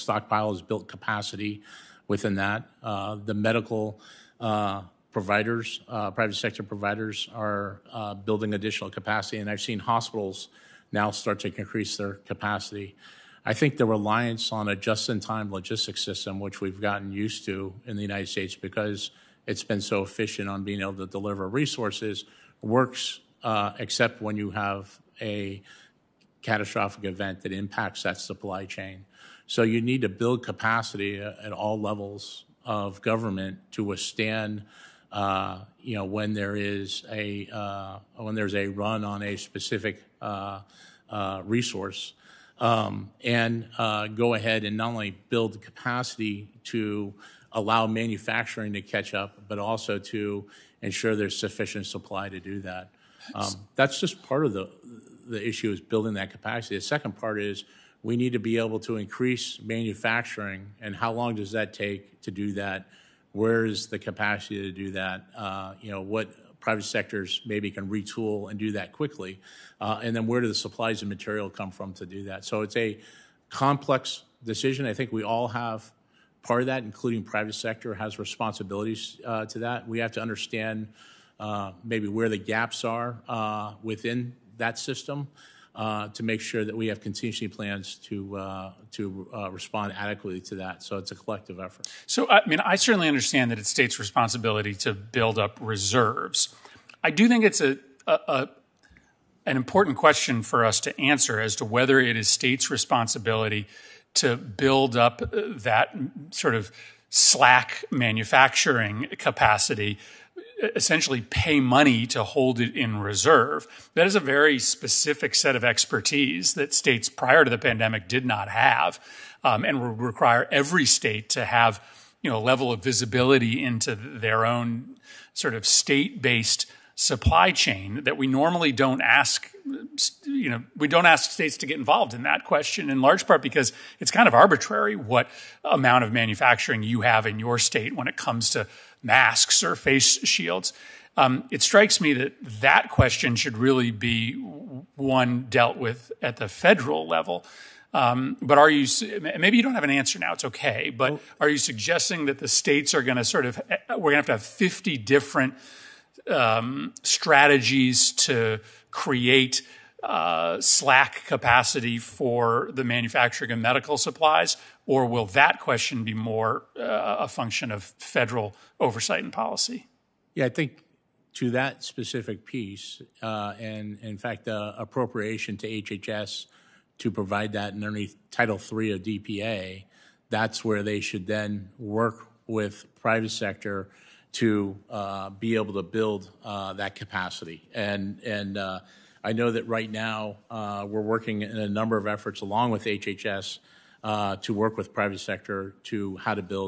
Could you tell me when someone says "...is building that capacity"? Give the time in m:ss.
0:55.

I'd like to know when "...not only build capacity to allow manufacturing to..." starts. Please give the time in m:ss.
0:44.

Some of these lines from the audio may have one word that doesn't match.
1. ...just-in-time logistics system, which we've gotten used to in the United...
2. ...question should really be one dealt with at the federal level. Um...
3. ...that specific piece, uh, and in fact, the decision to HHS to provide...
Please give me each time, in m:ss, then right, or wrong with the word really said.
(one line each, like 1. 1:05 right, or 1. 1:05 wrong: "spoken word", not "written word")
1. 0:14 right
2. 2:22 right
3. 2:51 wrong: "appropriation", not "decision".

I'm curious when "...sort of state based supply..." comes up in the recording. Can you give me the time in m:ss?
2:05.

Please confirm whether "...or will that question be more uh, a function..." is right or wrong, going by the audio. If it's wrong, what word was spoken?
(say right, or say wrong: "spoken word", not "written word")
right.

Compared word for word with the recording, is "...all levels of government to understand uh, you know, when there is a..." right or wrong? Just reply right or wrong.
wrong.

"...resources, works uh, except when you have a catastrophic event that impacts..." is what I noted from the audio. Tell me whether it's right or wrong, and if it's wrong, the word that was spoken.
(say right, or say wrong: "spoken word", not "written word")
right.